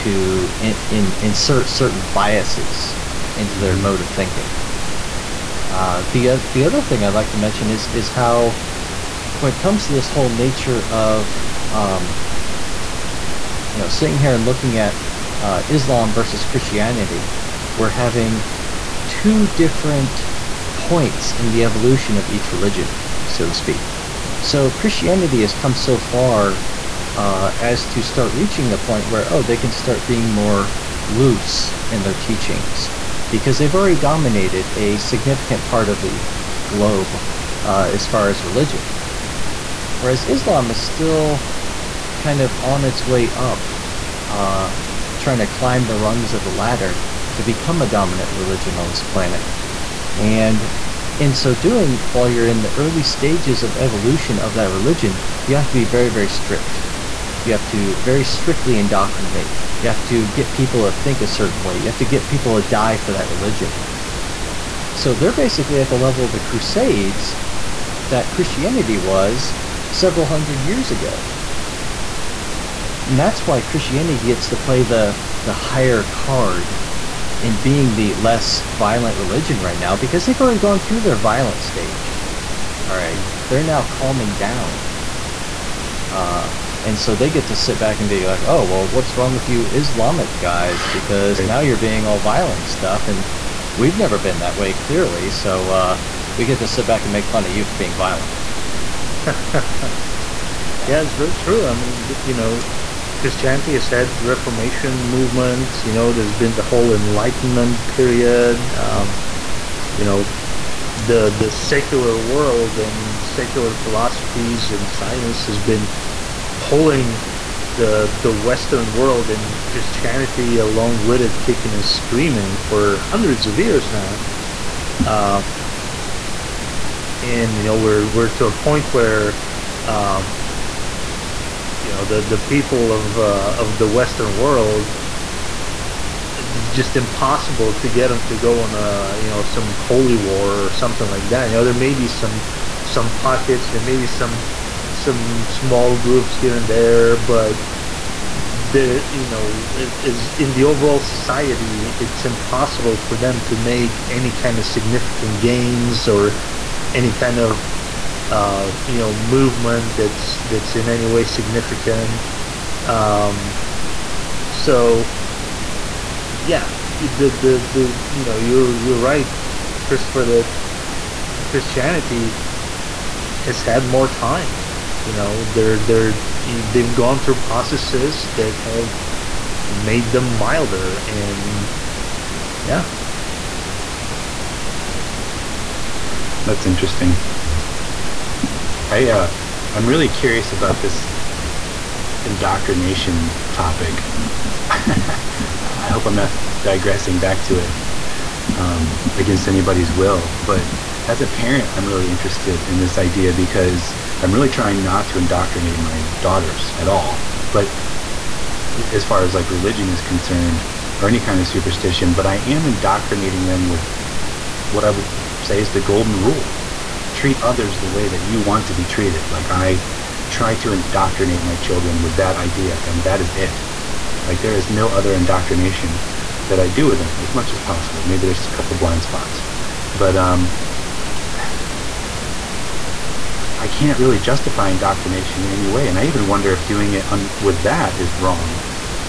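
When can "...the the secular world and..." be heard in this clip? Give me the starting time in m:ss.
1:50.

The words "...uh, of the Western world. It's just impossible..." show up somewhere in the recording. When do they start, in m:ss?
2:13.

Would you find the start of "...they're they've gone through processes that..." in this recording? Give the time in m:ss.
2:55.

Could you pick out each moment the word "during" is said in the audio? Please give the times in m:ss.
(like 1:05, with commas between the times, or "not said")
not said.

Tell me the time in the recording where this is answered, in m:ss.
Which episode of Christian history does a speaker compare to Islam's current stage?
1:06.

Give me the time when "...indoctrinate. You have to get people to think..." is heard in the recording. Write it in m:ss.
0:58.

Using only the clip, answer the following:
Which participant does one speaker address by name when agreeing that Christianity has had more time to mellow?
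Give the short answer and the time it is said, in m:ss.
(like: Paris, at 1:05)
Christopher, at 2:49.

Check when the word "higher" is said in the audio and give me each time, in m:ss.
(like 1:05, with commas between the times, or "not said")
1:15.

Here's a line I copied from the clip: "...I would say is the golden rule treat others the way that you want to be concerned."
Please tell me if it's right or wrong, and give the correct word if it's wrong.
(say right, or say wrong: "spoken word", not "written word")
wrong: "treated", not "concerned".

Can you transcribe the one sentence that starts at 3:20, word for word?
But as a parent, I'm really interested in this idea because I'm really trying not to indoctrinate my daughters at all.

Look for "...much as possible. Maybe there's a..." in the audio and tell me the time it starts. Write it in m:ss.
3:47.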